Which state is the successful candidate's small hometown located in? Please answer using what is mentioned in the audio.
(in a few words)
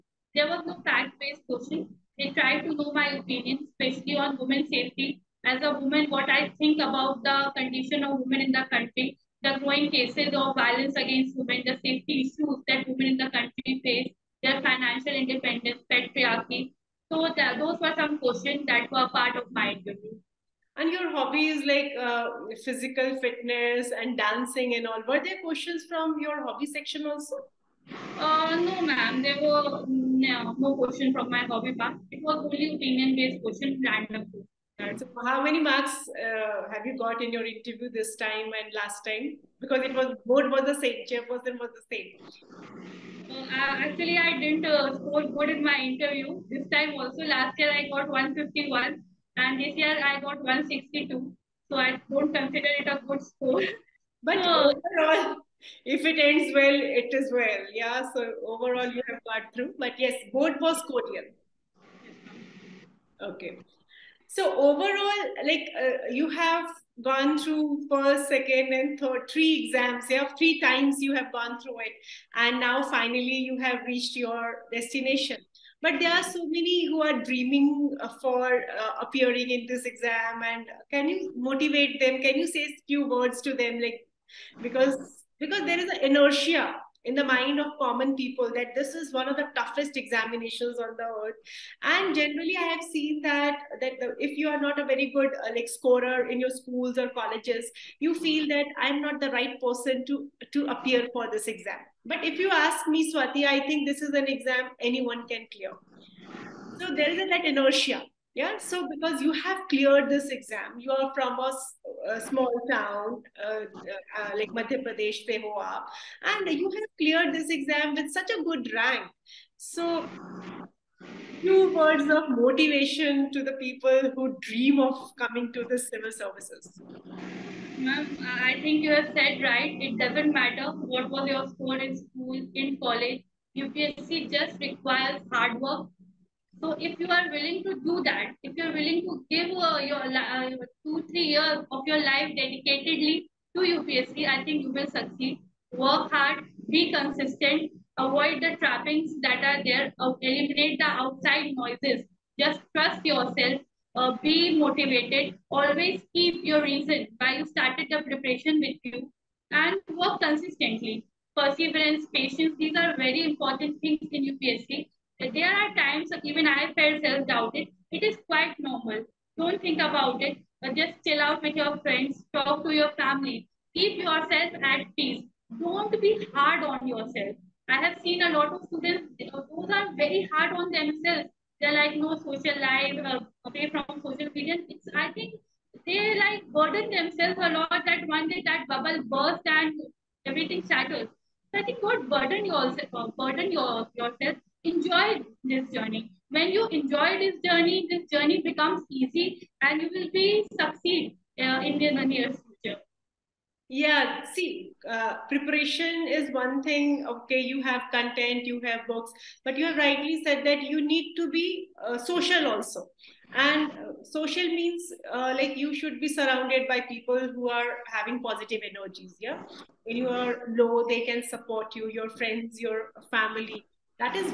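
Madhya Pradesh.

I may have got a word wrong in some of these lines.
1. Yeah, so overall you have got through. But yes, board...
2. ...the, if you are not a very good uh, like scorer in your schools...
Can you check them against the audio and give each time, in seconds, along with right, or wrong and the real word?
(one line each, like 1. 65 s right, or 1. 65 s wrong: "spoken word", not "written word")
1. 57 s right
2. 94 s right.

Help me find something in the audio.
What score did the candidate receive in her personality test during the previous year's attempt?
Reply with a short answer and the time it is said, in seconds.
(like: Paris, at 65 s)
151, at 48 s.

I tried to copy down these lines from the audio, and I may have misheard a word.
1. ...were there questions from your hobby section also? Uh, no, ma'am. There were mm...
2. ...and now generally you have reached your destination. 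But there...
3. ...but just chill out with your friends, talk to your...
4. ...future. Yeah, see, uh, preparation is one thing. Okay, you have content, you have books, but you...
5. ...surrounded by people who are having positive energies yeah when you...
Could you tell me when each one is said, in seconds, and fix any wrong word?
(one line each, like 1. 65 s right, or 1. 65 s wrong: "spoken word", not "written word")
1. 25 s right
2. 72 s wrong: "finally", not "generally"
3. 170 s right
4. 202 s right
5. 216 s right.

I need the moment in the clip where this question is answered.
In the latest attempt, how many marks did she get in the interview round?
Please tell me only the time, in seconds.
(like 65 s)
50 s.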